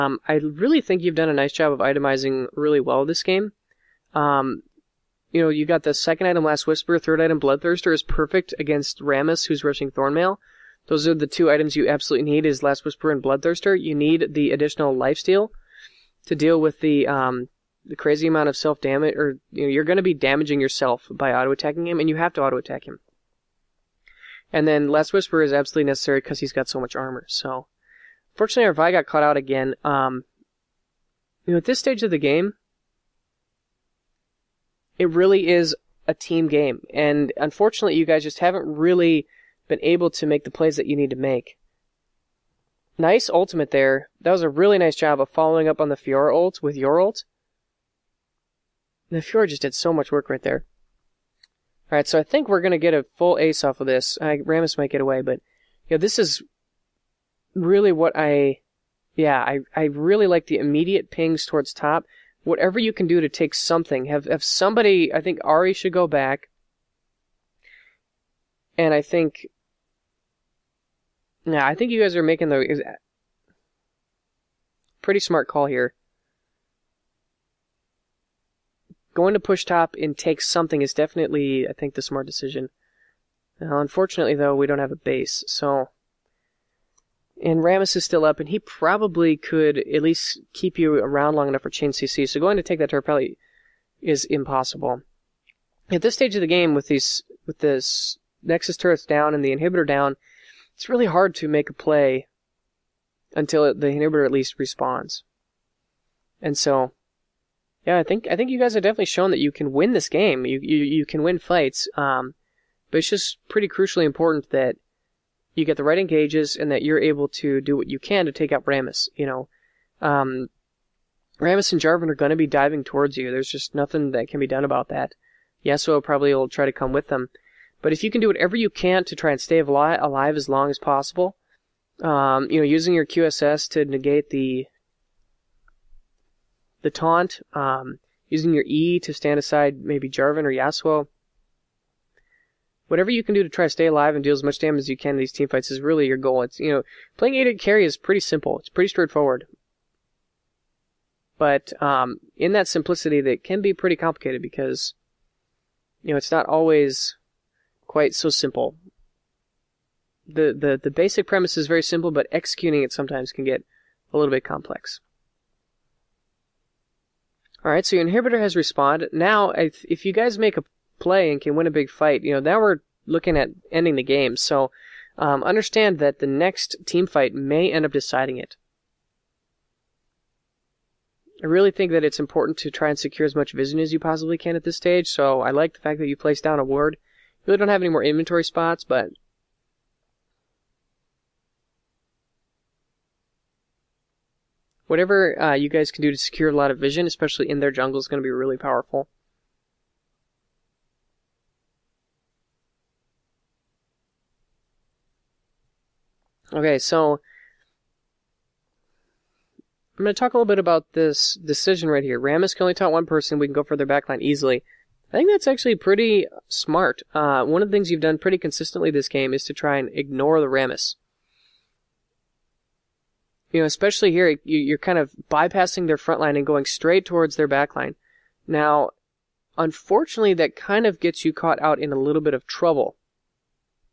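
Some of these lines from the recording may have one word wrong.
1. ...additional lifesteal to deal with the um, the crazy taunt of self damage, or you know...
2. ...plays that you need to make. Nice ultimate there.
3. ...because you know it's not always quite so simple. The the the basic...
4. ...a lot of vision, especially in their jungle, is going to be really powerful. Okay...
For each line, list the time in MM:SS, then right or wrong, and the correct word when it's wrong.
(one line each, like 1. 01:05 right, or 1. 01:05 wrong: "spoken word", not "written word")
1. 00:14 wrong: "amount", not "taunt"
2. 00:40 right
3. 02:34 right
4. 03:16 right.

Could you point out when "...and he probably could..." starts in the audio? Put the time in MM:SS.
01:28.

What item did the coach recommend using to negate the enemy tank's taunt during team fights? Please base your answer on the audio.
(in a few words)
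QSS.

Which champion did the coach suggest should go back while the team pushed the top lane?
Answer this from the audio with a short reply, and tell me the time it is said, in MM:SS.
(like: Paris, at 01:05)
Ahri, at 01:05.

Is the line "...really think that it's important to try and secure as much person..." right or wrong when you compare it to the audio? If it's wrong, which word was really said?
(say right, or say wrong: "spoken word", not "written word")
wrong: "vision", not "person".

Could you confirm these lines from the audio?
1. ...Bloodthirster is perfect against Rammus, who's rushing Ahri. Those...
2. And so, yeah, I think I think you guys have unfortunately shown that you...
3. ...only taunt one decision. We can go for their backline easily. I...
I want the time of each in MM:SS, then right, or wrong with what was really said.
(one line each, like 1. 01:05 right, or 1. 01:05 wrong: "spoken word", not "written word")
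1. 00:07 wrong: "Thornmail", not "Ahri"
2. 01:46 wrong: "definitely", not "unfortunately"
3. 03:32 wrong: "person", not "decision".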